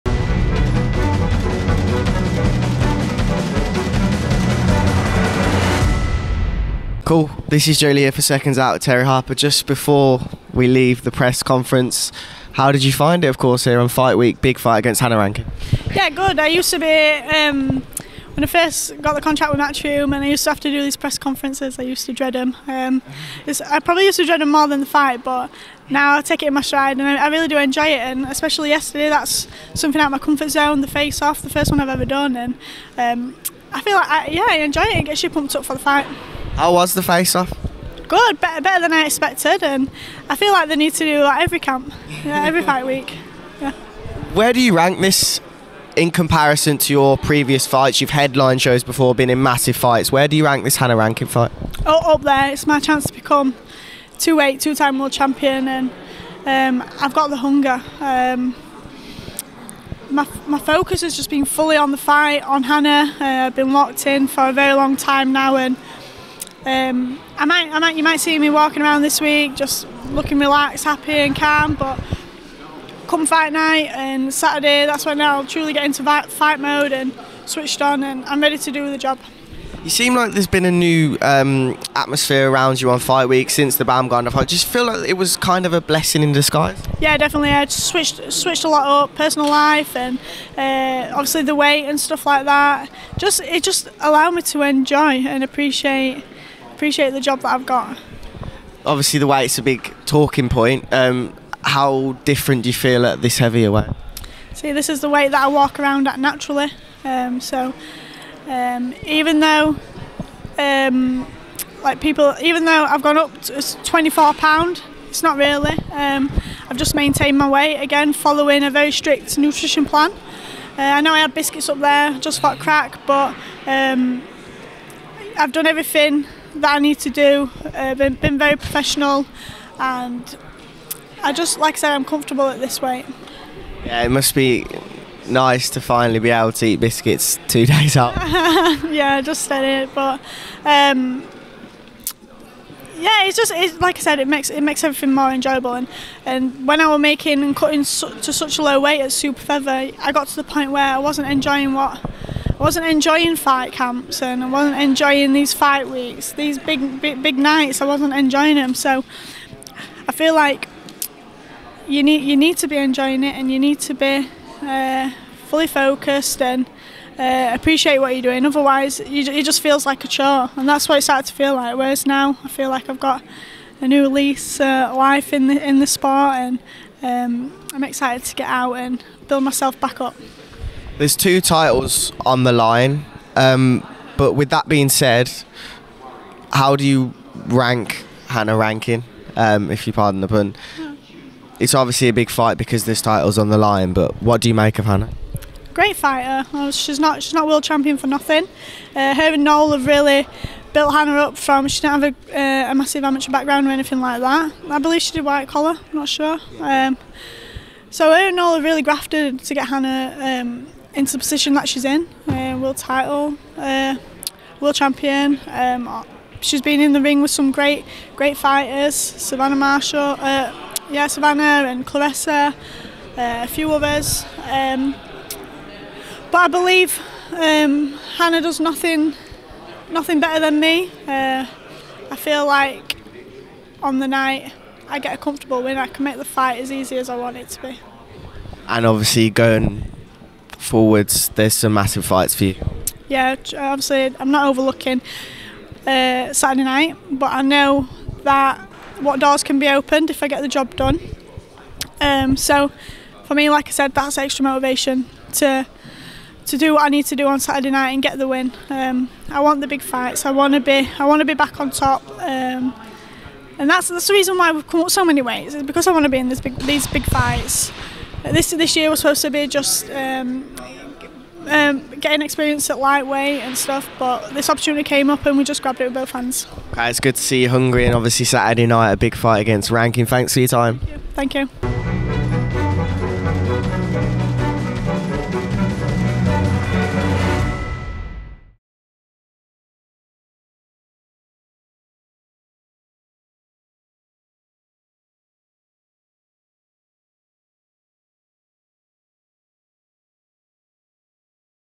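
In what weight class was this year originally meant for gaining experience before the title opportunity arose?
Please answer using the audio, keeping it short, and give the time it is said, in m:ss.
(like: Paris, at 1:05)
Lightweight, at 4:32.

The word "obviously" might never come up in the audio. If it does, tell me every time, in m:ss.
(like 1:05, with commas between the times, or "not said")
1:31, 1:38, 3:11, 3:58, 4:03, 4:37.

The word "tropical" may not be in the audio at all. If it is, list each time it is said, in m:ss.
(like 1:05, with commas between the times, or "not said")
not said.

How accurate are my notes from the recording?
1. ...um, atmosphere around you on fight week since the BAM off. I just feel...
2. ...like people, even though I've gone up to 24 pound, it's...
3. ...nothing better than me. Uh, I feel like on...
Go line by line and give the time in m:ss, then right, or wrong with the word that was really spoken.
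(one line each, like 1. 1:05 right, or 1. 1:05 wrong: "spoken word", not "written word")
1. 1:21 right
2. 1:51 right
3. 3:49 right.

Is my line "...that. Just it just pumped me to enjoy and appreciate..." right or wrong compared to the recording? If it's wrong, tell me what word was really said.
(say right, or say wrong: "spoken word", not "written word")
wrong: "allowed", not "pumped".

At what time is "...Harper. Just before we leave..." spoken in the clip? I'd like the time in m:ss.
0:09.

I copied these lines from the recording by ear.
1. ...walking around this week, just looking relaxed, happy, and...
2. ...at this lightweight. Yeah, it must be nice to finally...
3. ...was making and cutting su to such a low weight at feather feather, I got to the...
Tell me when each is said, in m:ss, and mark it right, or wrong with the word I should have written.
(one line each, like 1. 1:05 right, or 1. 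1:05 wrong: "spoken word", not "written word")
1. 1:08 right
2. 2:12 wrong: "weight", not "lightweight"
3. 2:26 wrong: "super", not "feather".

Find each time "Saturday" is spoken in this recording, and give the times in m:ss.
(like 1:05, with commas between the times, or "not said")
1:14, 4:06, 4:17, 4:38.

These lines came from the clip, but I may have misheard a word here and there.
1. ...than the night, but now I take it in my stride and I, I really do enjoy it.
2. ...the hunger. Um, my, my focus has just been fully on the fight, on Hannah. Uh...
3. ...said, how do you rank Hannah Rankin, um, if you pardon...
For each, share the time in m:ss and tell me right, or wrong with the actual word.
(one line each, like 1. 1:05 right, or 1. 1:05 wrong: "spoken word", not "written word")
1. 0:24 wrong: "fight", not "night"
2. 0:57 right
3. 3:04 right.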